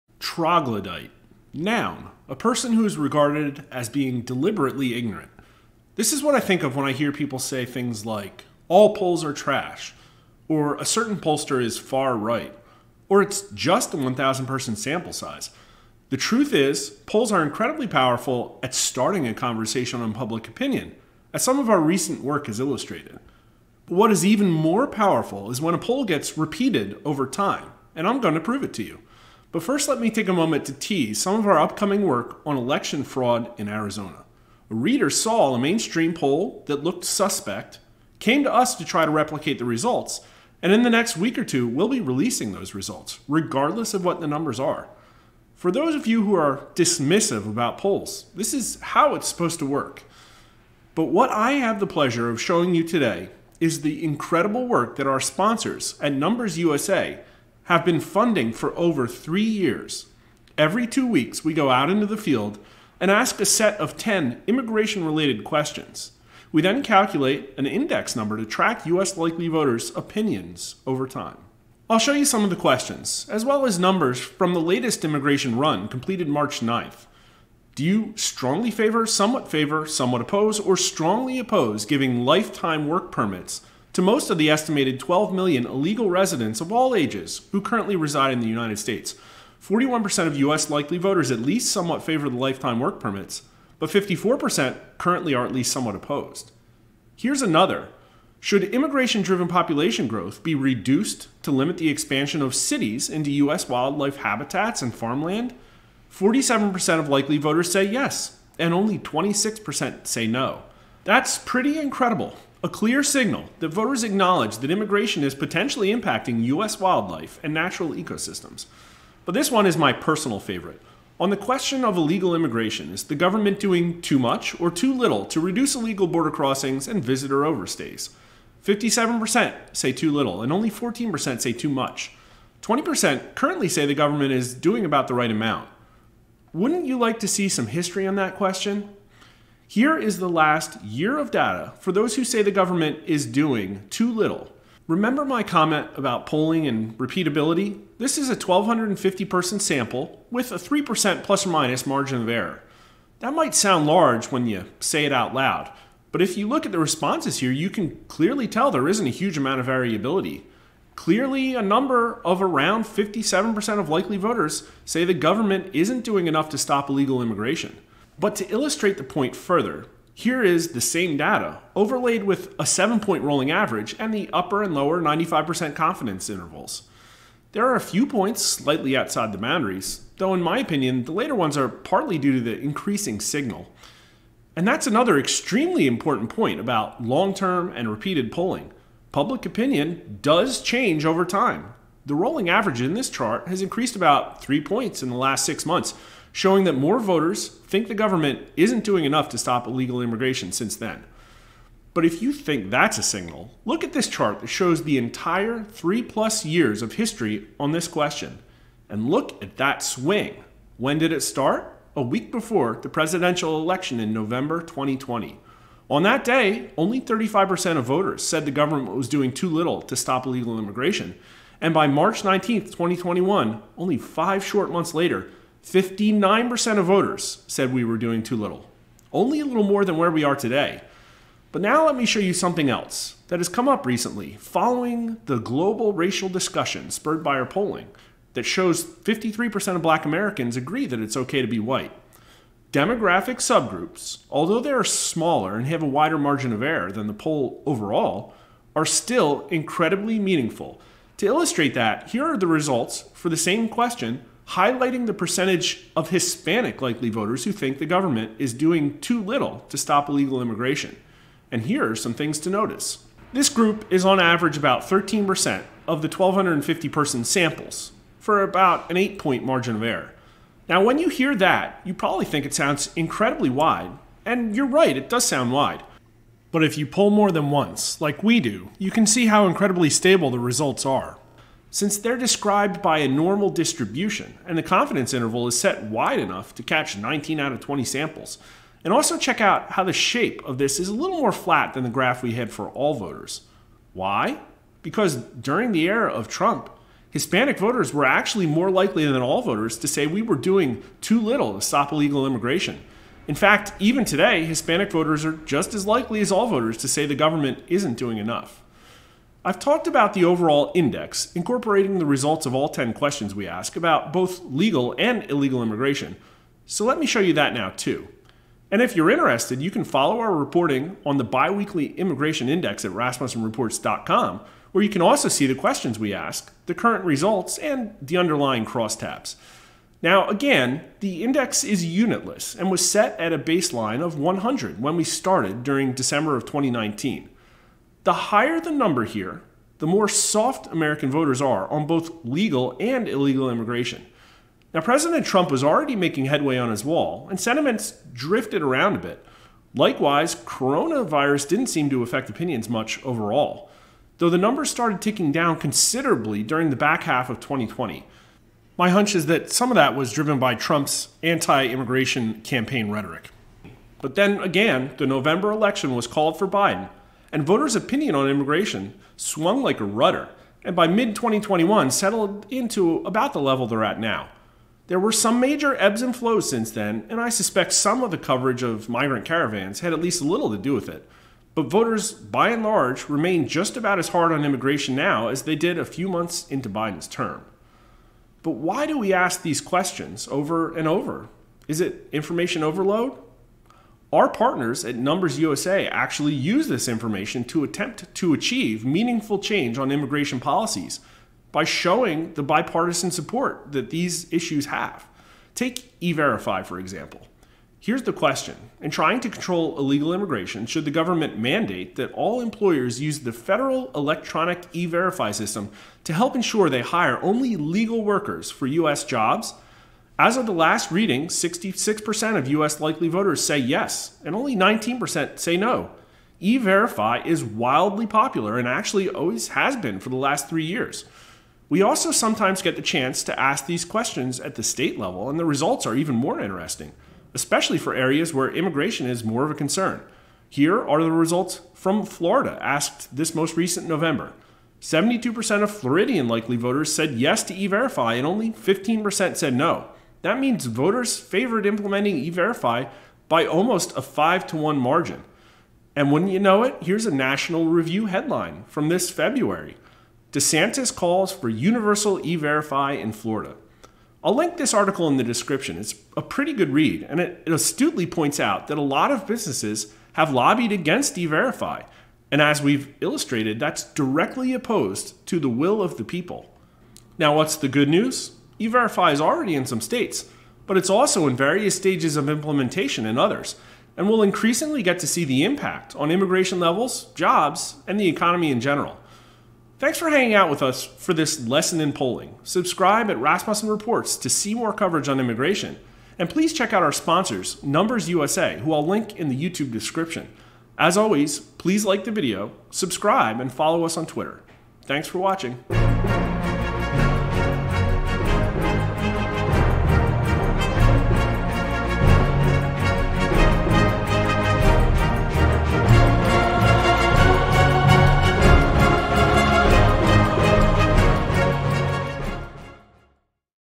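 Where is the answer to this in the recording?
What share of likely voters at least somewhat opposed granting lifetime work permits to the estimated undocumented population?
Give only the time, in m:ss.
1:33.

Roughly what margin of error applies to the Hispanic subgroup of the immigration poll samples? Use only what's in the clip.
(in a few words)
8 points.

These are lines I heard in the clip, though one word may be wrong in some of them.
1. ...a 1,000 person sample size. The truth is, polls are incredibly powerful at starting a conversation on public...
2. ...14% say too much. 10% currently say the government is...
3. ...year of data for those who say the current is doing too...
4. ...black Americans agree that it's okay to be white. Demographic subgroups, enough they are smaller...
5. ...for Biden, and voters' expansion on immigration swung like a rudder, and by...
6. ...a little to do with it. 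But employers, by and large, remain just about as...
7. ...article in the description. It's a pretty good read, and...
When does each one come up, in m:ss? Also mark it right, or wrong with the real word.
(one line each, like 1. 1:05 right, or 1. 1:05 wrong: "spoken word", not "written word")
1. 0:13 right
2. 2:10 wrong: "20", not "10"
3. 2:20 wrong: "government", not "current"
4. 3:59 wrong: "although", not "enough"
5. 6:06 wrong: "opinion", not "expansion"
6. 6:20 wrong: "voters", not "employers"
7. 7:44 right.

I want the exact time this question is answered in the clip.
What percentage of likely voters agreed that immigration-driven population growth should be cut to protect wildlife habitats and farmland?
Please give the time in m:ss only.
1:46.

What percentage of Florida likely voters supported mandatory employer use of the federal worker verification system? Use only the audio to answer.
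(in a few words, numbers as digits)
72%.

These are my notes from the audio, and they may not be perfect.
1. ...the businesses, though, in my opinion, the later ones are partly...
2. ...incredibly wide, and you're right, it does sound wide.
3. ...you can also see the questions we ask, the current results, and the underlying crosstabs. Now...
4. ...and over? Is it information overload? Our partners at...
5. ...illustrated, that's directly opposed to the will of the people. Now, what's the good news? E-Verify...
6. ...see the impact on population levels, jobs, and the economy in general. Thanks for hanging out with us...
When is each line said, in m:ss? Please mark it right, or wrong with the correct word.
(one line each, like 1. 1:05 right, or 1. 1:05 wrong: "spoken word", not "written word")
1. 2:59 wrong: "boundaries", not "businesses"
2. 4:32 right
3. 5:24 right
4. 6:30 right
5. 7:53 right
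6. 8:05 wrong: "immigration", not "population".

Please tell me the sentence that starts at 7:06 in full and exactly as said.
E Verify is wildly popular and actually always has been for the last three years.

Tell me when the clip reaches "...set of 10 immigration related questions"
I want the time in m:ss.
1:03.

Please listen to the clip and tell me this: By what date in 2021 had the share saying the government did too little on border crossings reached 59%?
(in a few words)
March 19, 2021.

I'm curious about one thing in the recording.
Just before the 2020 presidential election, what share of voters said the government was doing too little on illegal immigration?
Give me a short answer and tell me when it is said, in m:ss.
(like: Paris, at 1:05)
35%, at 3:37.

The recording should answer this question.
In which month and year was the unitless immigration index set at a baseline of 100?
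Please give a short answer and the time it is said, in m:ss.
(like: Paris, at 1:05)
December 2019, at 5:35.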